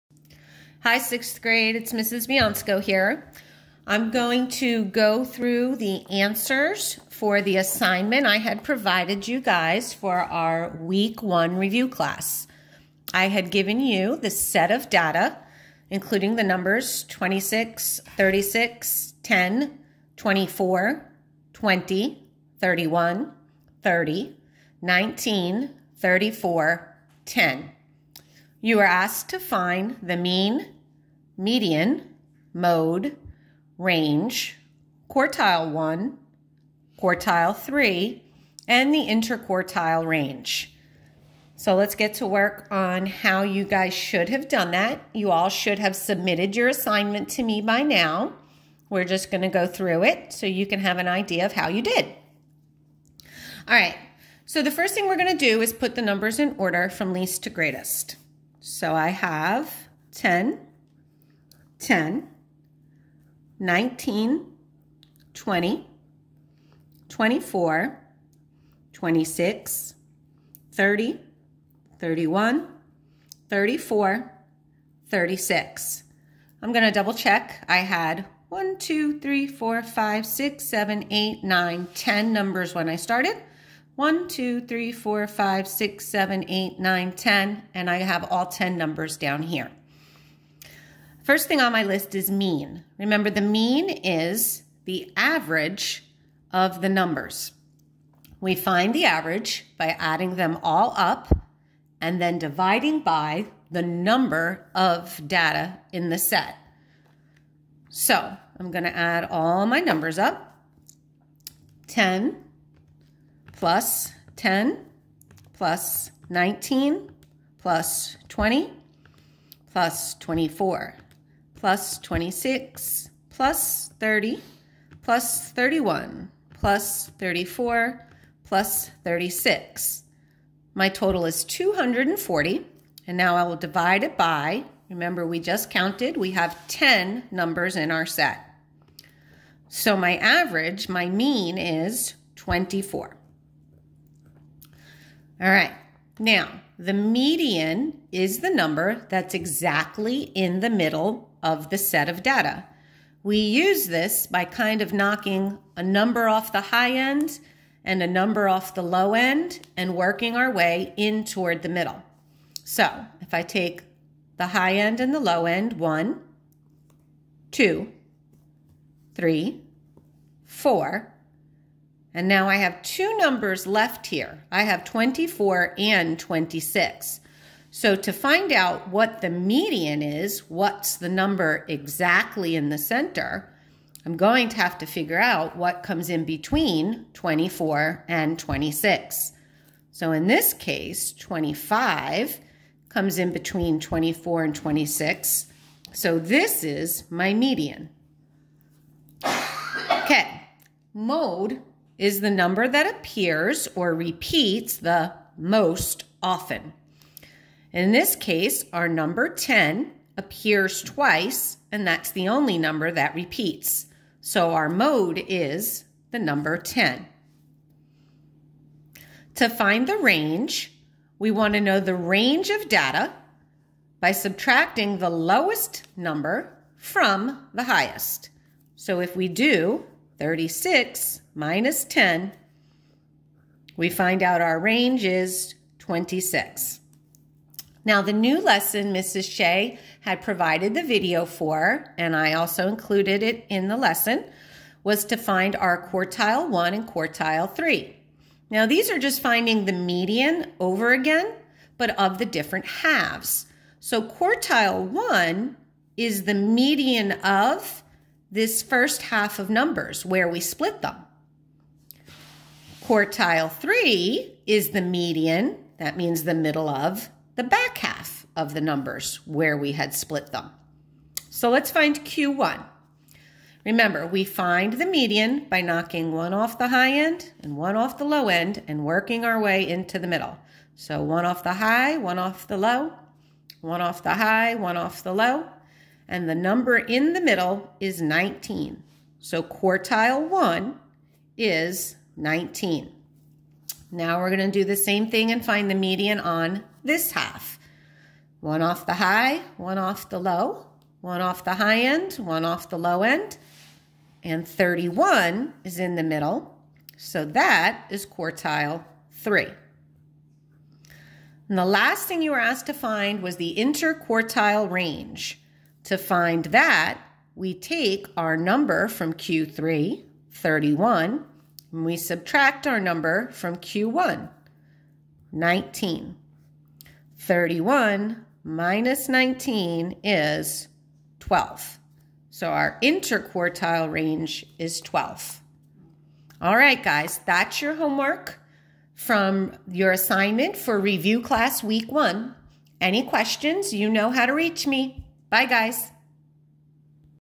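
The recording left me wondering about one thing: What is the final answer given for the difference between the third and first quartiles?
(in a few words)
12.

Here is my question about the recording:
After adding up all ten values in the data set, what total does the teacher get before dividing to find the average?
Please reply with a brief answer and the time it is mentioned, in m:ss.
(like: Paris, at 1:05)
240, at 2:11.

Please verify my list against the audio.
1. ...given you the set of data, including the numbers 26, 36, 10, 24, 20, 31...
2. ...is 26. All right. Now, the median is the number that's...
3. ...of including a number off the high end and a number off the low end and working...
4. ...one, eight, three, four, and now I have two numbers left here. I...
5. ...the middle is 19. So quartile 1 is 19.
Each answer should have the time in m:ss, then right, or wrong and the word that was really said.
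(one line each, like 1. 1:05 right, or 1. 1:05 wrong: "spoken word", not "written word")
1. 0:13 right
2. 2:21 wrong: "24", not "26"
3. 2:34 wrong: "knocking", not "including"
4. 2:45 wrong: "two", not "eight"
5. 4:47 right.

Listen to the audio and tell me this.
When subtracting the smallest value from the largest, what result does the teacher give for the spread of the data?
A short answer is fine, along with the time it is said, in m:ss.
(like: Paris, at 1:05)
26, at 3:54.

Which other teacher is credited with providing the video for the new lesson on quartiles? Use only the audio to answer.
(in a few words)
Mrs. Shea.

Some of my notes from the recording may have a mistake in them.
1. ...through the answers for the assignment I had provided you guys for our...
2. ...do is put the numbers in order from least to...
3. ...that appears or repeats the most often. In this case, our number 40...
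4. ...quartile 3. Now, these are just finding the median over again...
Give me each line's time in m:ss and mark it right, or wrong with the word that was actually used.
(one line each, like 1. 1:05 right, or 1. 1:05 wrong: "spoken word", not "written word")
1. 0:05 right
2. 0:55 right
3. 3:22 wrong: "10", not "40"
4. 4:06 right.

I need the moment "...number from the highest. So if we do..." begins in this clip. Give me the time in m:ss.
3:45.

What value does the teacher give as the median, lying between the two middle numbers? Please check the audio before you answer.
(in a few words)
25.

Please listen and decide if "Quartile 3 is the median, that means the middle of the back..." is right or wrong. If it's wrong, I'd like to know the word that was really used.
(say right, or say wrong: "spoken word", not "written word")
right.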